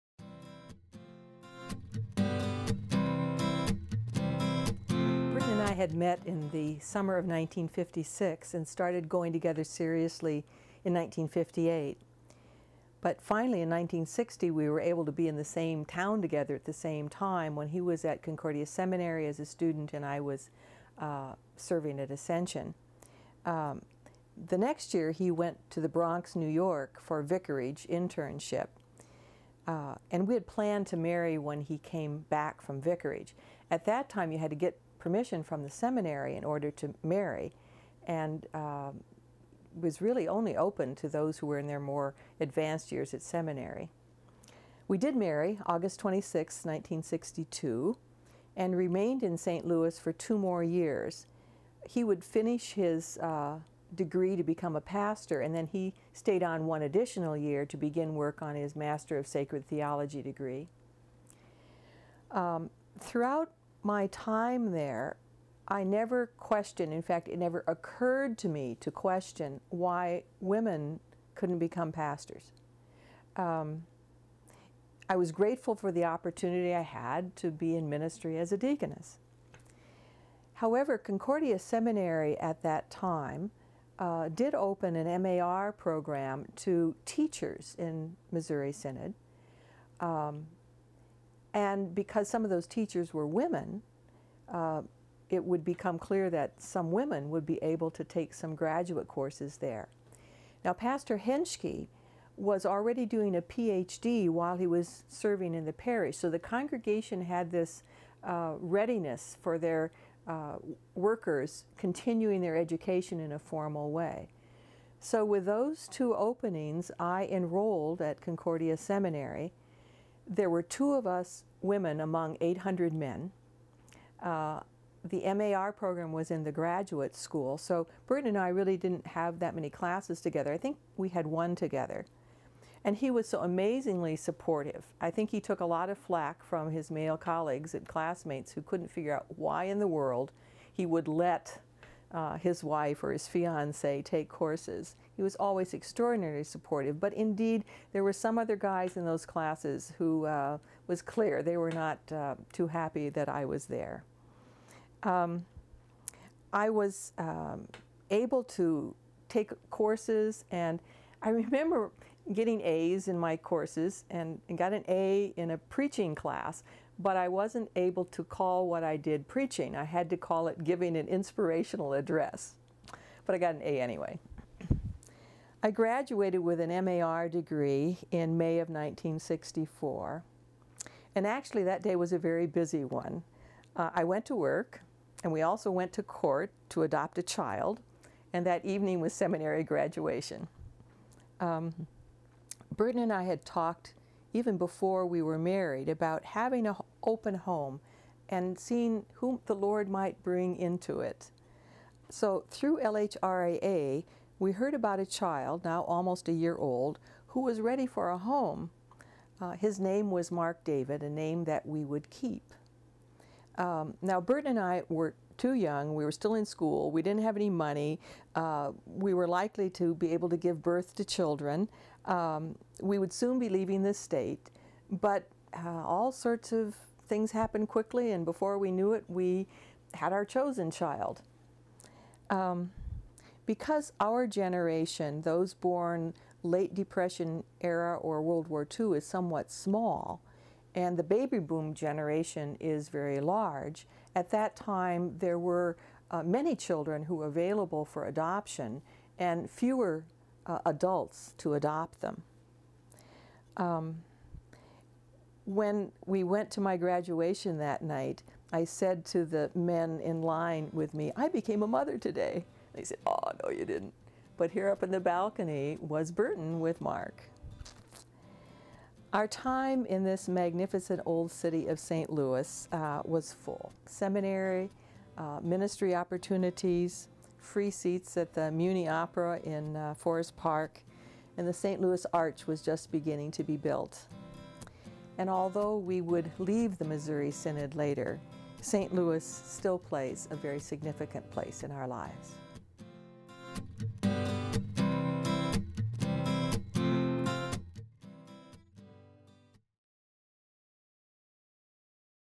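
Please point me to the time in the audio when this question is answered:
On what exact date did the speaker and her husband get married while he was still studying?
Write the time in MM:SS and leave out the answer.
00:45.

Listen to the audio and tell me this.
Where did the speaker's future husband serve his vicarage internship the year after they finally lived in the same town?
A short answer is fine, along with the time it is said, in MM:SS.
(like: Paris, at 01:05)
Bronx, New York, at 00:25.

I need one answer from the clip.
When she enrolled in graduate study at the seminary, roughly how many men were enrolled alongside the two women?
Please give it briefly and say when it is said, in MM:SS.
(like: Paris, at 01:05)
800, at 02:02.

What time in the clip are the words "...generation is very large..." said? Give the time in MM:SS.
04:01.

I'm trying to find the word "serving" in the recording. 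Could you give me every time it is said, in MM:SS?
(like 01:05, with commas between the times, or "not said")
00:21, 01:45.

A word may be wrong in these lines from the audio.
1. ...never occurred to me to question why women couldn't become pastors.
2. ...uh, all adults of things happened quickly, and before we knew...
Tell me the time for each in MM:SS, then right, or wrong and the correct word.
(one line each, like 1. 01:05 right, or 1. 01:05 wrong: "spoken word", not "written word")
1. 01:07 right
2. 03:45 wrong: "sorts", not "adults".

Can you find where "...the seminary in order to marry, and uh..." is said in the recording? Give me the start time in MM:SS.
00:35.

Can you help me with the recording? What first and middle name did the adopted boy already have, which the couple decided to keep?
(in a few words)
Mark David.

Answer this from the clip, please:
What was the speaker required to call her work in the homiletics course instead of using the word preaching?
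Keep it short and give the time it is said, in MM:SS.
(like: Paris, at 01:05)
inspirational address, at 02:51.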